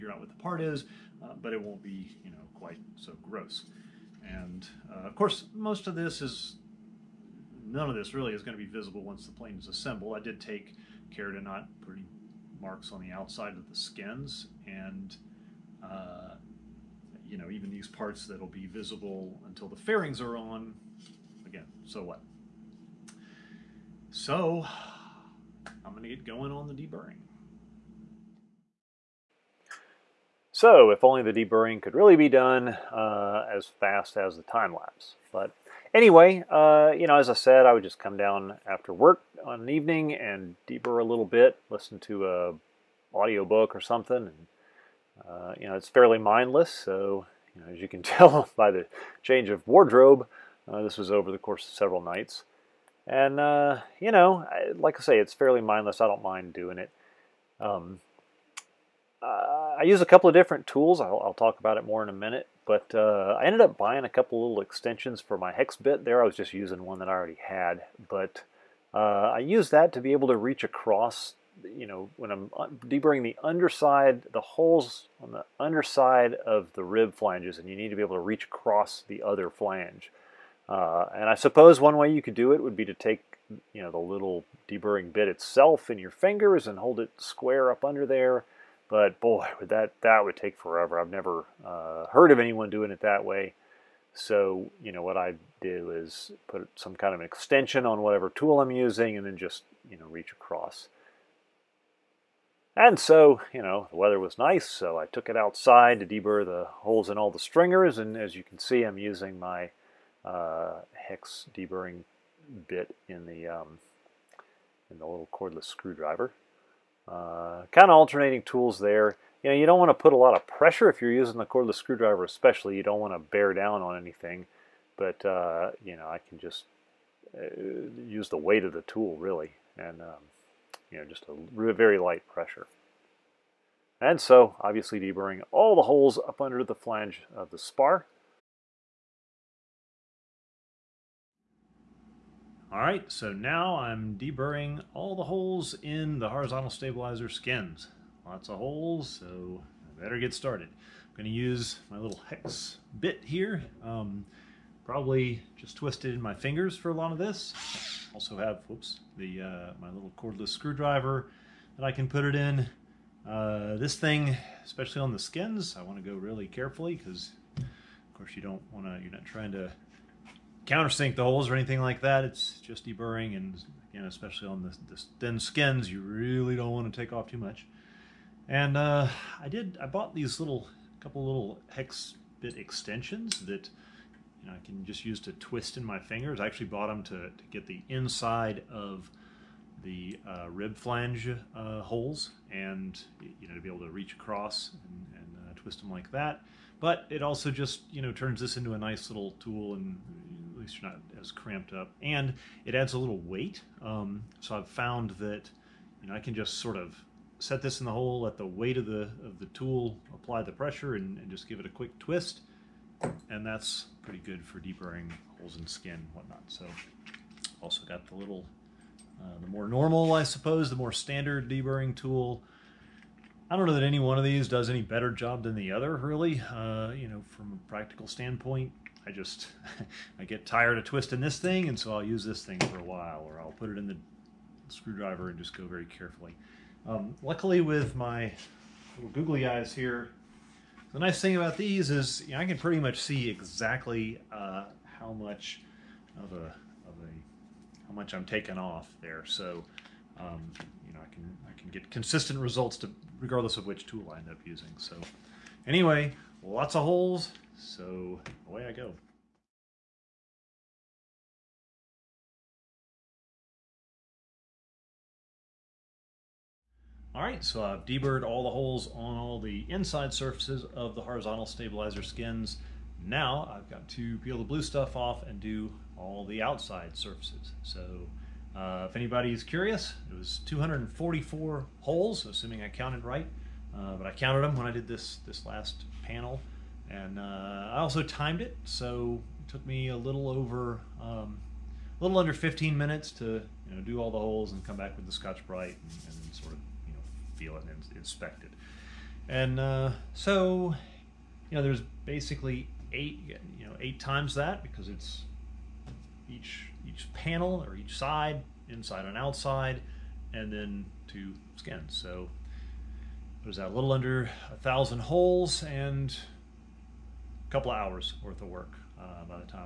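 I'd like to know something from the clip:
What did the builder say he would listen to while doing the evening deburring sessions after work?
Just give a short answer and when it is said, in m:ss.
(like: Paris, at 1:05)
audiobook, at 0:43.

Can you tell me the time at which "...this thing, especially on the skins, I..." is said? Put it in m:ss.
2:43.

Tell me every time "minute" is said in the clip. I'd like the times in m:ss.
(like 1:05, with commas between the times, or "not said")
1:02, 4:52.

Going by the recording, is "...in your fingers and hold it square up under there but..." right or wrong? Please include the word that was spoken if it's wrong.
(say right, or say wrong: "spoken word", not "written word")
right.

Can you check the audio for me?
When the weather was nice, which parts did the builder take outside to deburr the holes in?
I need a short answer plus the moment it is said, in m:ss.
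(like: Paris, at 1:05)
stringers, at 1:47.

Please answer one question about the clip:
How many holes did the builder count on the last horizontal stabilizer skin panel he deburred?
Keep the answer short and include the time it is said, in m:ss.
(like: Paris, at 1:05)
244, at 4:40.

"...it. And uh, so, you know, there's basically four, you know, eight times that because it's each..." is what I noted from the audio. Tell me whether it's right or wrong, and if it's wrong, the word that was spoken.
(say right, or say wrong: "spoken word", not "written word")
wrong: "eight", not "four".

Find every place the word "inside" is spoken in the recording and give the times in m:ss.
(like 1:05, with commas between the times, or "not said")
3:07, 4:29, 5:08.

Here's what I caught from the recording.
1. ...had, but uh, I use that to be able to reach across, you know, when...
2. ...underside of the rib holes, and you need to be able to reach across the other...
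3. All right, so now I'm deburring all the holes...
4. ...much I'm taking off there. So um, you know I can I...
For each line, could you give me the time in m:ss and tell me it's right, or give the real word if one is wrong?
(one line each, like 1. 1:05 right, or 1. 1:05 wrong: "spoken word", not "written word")
1. 1:07 right
2. 1:15 wrong: "flanges", not "holes"
3. 2:22 right
4. 4:07 right.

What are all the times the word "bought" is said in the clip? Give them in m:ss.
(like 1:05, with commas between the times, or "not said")
2:59, 3:06.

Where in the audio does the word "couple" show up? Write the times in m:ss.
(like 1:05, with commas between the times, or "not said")
1:00, 1:04, 3:01, 5:17.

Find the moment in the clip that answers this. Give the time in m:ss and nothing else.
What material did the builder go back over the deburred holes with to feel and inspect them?
4:55.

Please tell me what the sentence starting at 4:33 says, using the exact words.
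Now I've got to peel the blue stuff off and do all the outside surfaces.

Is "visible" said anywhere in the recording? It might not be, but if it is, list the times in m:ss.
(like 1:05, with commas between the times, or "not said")
0:08, 0:18.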